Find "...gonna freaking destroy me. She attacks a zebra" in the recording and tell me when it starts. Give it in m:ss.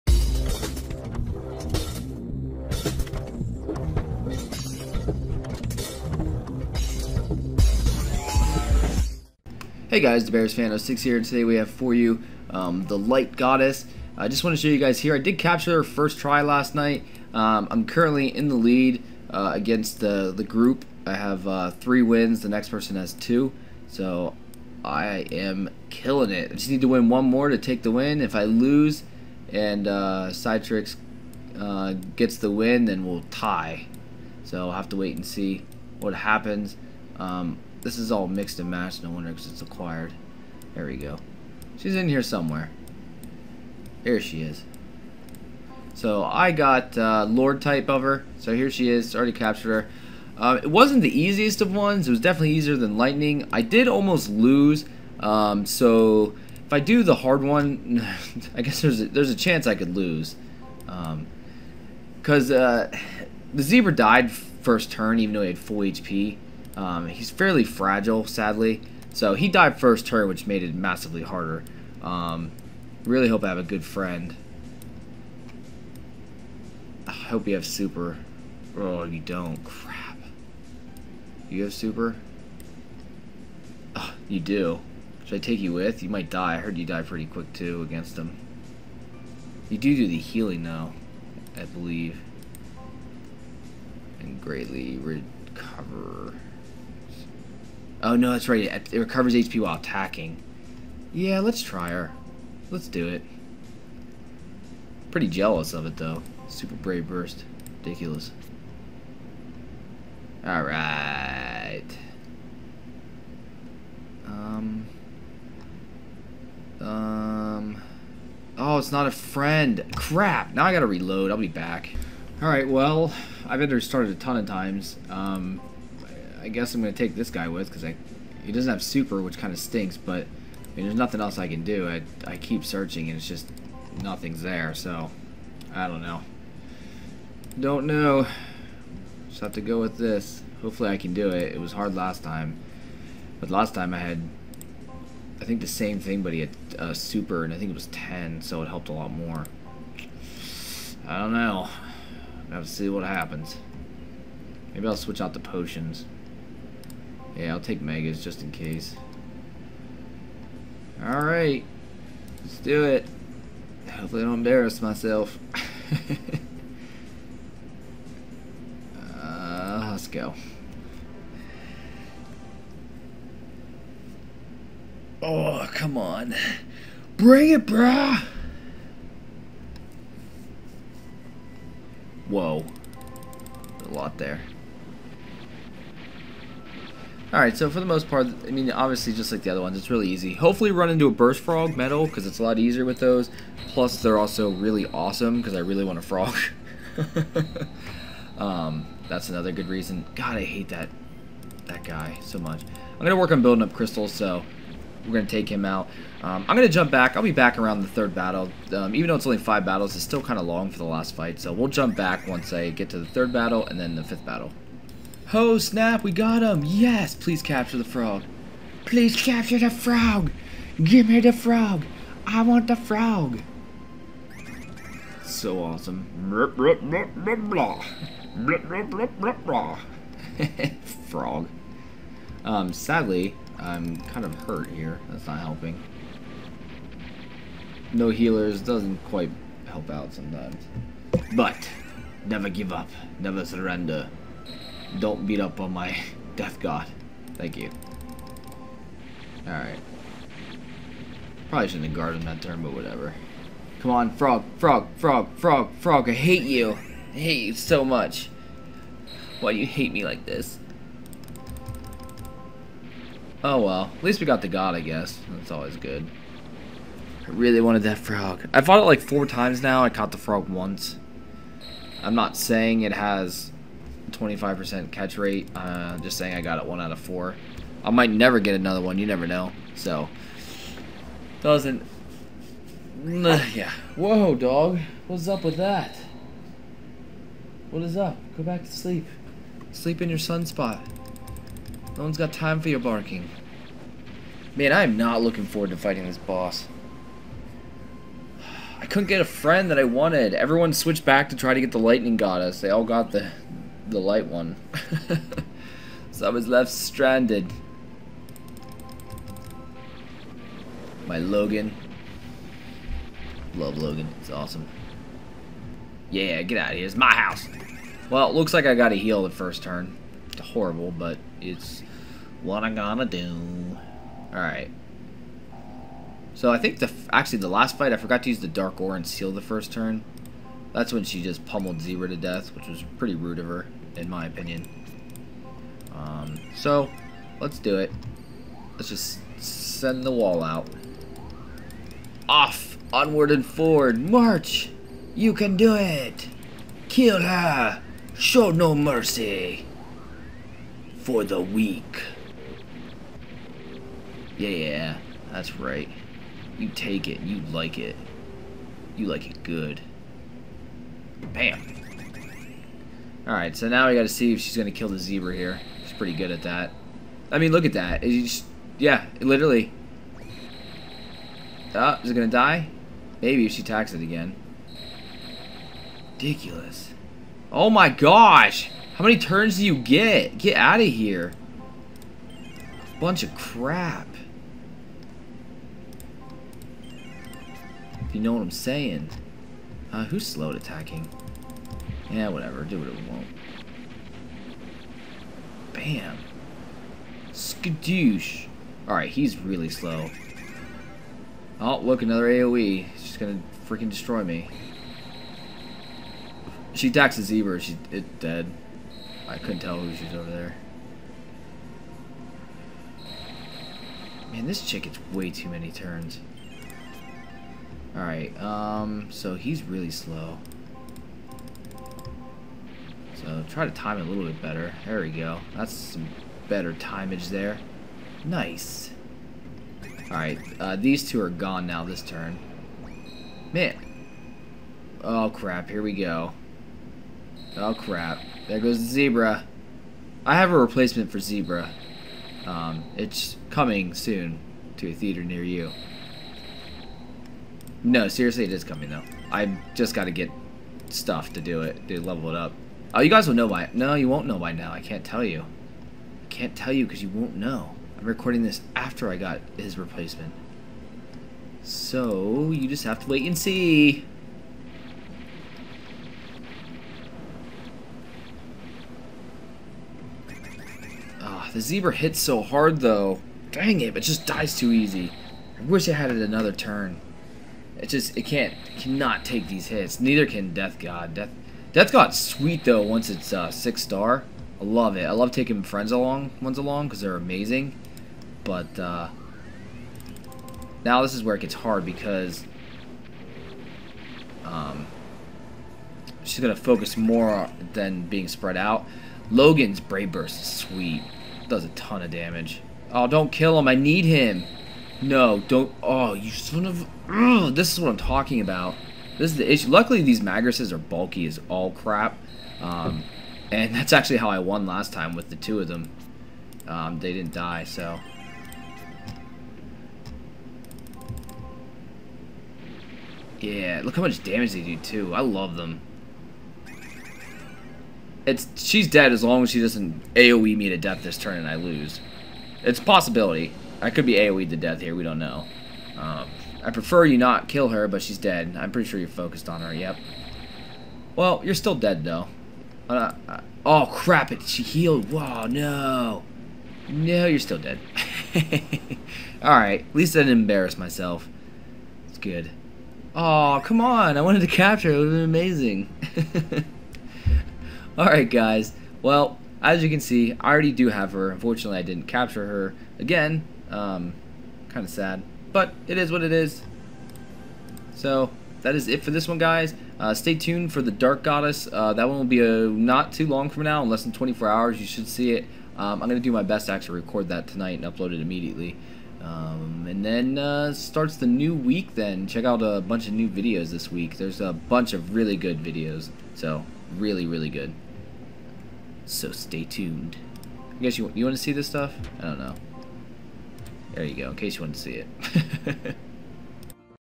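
6:43.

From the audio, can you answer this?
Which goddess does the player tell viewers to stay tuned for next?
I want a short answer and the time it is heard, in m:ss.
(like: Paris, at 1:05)
Dark Goddess, at 9:30.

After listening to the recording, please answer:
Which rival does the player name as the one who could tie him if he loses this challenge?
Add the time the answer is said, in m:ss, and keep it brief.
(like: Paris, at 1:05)
Cytrix, at 0:30.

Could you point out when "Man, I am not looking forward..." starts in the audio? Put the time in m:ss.
4:54.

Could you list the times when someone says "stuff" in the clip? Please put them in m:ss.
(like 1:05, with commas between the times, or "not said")
7:30, 9:51.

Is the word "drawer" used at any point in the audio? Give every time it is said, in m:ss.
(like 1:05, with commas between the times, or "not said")
not said.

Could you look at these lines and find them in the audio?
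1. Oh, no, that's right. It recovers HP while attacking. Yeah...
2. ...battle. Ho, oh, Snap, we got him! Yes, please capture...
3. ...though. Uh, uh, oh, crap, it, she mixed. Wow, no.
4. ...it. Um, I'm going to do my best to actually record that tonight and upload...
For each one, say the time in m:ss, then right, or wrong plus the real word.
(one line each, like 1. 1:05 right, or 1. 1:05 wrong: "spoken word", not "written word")
1. 1:38 right
2. 3:34 right
3. 9:02 wrong: "healed", not "mixed"
4. 9:35 right.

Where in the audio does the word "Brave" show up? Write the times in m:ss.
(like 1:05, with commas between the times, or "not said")
1:46, 8:19.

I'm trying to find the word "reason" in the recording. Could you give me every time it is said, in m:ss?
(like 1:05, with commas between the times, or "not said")
3:19.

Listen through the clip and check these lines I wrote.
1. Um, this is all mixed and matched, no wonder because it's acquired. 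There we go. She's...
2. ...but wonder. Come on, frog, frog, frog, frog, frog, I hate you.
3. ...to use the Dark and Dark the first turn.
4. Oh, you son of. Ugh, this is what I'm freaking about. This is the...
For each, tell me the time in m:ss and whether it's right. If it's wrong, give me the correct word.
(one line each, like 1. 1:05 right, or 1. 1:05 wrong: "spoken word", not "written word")
1. 0:37 right
2. 4:12 wrong: "whatever", not "wonder"
3. 5:28 wrong: "Seal", not "Dark"
4. 8:25 wrong: "talking", not "freaking".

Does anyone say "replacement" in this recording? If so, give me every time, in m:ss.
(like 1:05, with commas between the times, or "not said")
7:20, 7:39.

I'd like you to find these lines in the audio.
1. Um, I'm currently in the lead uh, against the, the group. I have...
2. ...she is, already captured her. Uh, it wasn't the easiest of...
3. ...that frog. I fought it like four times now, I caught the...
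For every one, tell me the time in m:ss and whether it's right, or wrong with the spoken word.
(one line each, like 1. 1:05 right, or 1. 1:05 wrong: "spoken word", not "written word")
1. 0:17 right
2. 0:48 right
3. 4:27 right.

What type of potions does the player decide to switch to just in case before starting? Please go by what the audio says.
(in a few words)
Megas.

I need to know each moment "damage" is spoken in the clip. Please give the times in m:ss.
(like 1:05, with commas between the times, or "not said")
8:22, 8:44.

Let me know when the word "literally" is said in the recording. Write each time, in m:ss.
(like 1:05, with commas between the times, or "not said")
6:09.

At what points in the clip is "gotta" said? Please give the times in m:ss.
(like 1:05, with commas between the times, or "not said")
2:00, 6:03.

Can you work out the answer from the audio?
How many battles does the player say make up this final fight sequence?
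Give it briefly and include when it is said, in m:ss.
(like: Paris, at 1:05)
5, at 3:29.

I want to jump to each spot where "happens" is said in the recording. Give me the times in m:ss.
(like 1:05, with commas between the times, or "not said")
0:36, 2:33.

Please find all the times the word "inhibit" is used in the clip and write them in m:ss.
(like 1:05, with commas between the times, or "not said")
not said.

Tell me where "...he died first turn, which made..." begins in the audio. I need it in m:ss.
1:09.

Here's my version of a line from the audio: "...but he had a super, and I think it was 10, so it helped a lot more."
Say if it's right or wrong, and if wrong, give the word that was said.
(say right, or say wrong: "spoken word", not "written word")
right.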